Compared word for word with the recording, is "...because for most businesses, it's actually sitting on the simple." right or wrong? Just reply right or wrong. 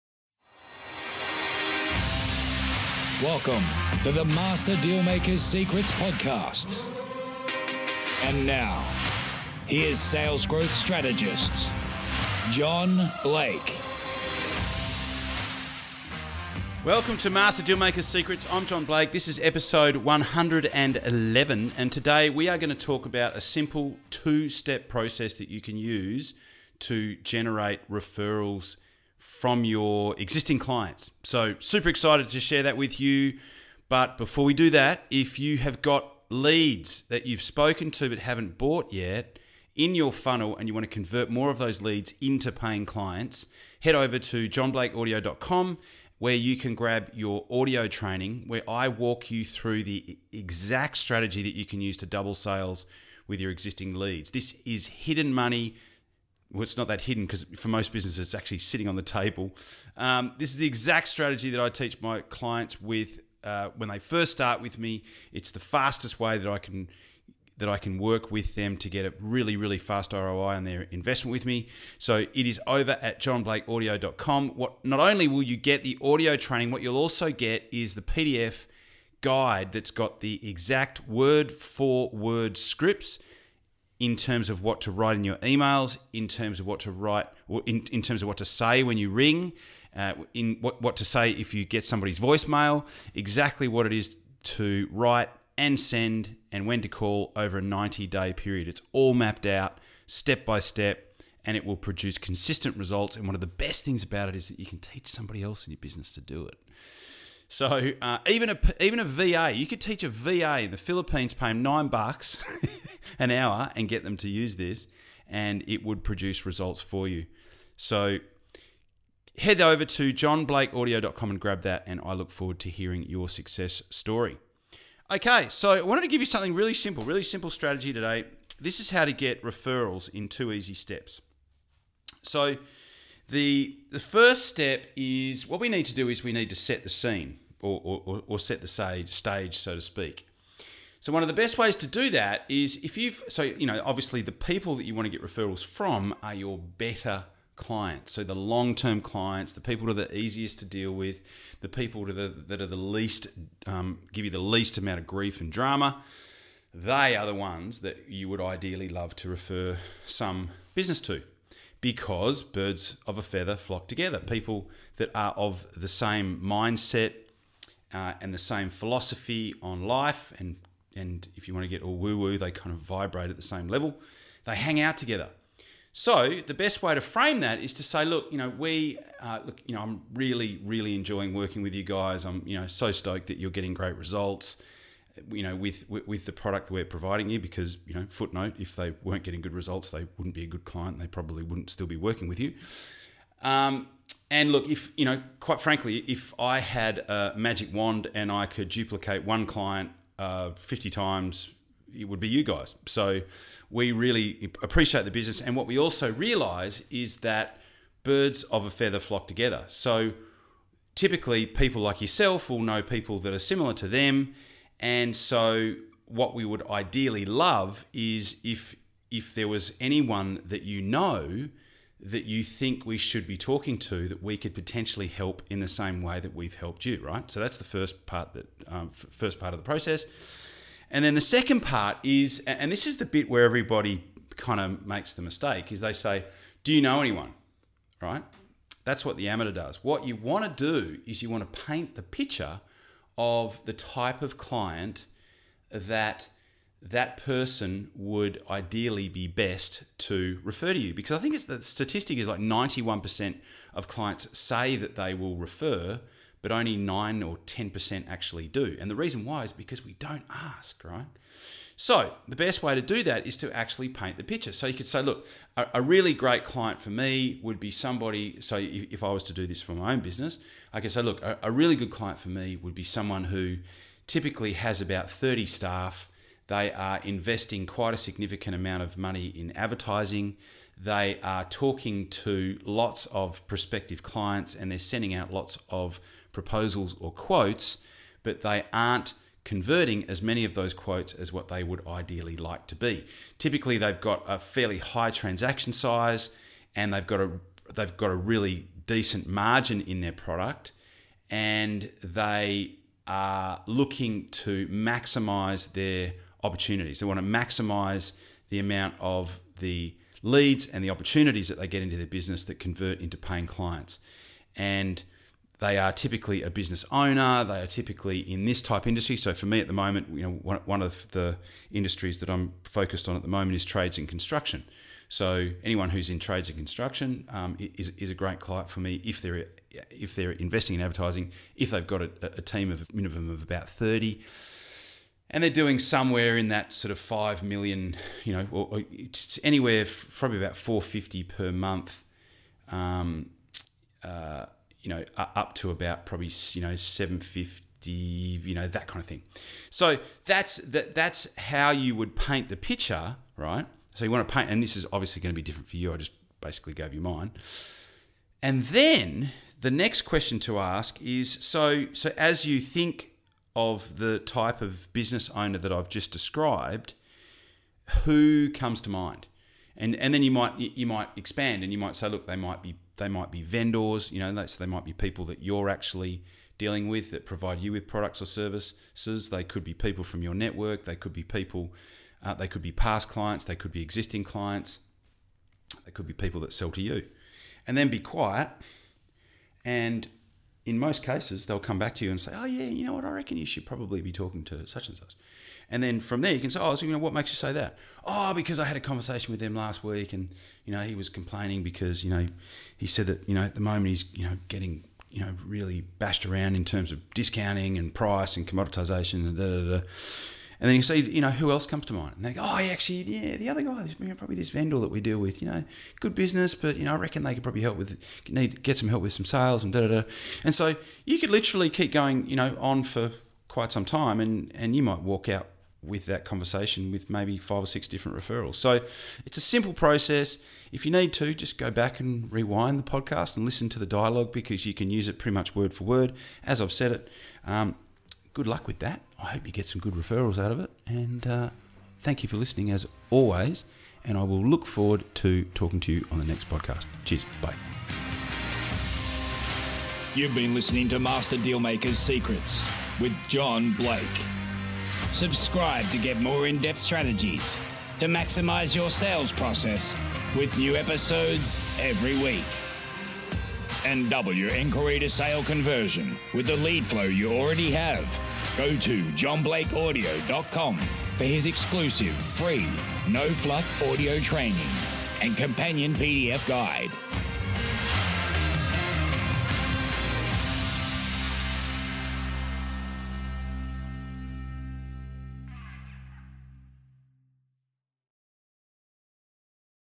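wrong.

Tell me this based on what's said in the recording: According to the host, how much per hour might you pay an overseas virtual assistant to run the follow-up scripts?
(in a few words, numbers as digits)
9 bucks.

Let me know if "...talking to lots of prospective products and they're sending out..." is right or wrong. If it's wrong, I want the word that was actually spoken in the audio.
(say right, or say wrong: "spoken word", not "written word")
wrong: "clients", not "products".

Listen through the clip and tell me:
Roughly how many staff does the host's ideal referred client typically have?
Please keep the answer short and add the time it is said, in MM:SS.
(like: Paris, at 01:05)
30, at 04:35.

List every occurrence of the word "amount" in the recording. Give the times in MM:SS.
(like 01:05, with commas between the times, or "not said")
02:34, 04:38, 05:08.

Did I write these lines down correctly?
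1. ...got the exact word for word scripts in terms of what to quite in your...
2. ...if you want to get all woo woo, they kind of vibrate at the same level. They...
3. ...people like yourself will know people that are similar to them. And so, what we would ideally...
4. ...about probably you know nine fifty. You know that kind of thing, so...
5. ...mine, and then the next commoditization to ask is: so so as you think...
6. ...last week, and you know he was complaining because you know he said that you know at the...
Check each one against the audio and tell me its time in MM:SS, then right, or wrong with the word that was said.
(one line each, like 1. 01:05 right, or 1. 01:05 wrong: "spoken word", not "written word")
1. 01:19 wrong: "write", not "quite"
2. 02:51 right
3. 03:31 right
4. 05:45 wrong: "seven", not "nine"
5. 05:57 wrong: "question", not "commoditization"
6. 06:39 right.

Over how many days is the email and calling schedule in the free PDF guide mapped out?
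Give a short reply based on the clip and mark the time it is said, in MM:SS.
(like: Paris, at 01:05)
90, at 01:37.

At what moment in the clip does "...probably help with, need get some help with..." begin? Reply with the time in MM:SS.
06:57.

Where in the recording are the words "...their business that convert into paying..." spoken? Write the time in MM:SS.
05:11.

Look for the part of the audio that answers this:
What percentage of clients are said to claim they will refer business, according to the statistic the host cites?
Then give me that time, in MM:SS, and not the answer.
04:12.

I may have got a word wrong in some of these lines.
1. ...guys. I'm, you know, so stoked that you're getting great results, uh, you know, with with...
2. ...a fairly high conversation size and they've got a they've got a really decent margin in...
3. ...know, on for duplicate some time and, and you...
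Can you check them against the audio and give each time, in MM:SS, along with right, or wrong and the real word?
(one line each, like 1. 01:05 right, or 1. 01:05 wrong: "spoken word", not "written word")
1. 03:01 right
2. 04:54 wrong: "transaction", not "conversation"
3. 07:02 wrong: "quite", not "duplicate".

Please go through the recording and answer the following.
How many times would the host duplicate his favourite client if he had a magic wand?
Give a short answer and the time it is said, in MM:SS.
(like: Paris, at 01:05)
50, at 03:20.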